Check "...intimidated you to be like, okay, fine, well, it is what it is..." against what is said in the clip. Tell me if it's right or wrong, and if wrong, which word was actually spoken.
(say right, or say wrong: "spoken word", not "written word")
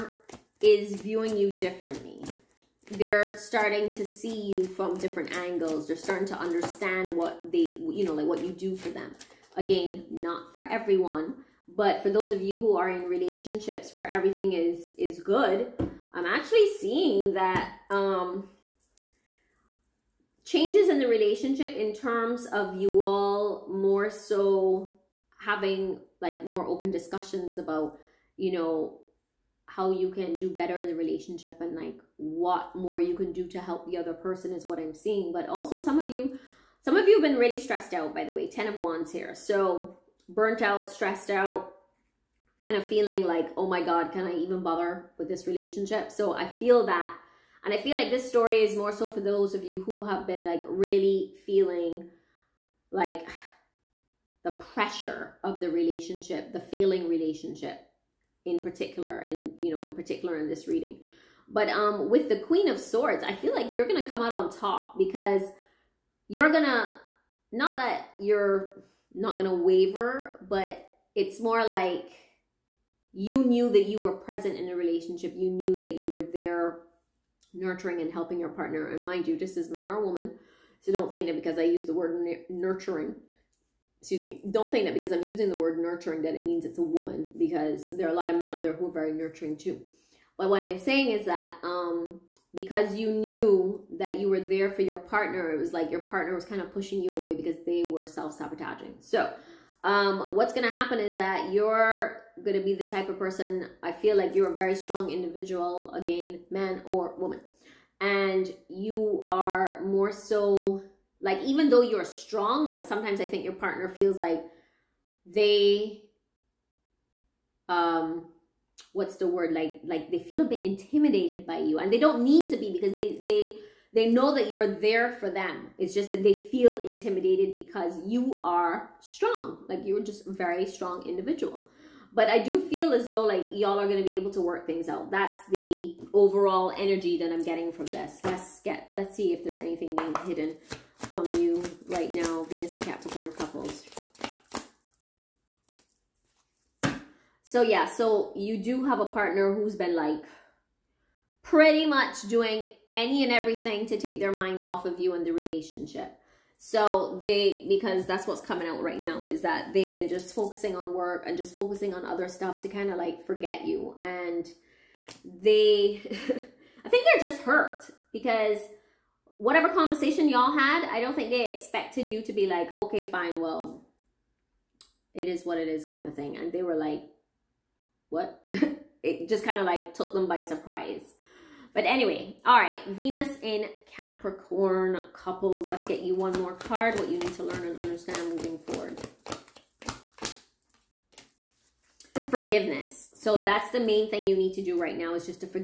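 wrong: "expected", not "intimidated".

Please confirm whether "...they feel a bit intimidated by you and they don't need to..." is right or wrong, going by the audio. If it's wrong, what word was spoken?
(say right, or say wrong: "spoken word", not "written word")
right.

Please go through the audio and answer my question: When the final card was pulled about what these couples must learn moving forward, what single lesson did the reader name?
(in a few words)
Forgiveness.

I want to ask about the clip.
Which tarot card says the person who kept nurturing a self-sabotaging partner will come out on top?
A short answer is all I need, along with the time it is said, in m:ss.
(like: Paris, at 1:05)
Queen of Swords, at 1:02.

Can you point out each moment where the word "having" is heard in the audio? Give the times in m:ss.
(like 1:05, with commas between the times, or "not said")
0:25.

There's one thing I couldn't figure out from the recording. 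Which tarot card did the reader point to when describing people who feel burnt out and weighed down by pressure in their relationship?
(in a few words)
10 of Wands.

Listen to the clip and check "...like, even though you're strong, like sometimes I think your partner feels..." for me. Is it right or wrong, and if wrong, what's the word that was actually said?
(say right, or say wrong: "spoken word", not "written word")
right.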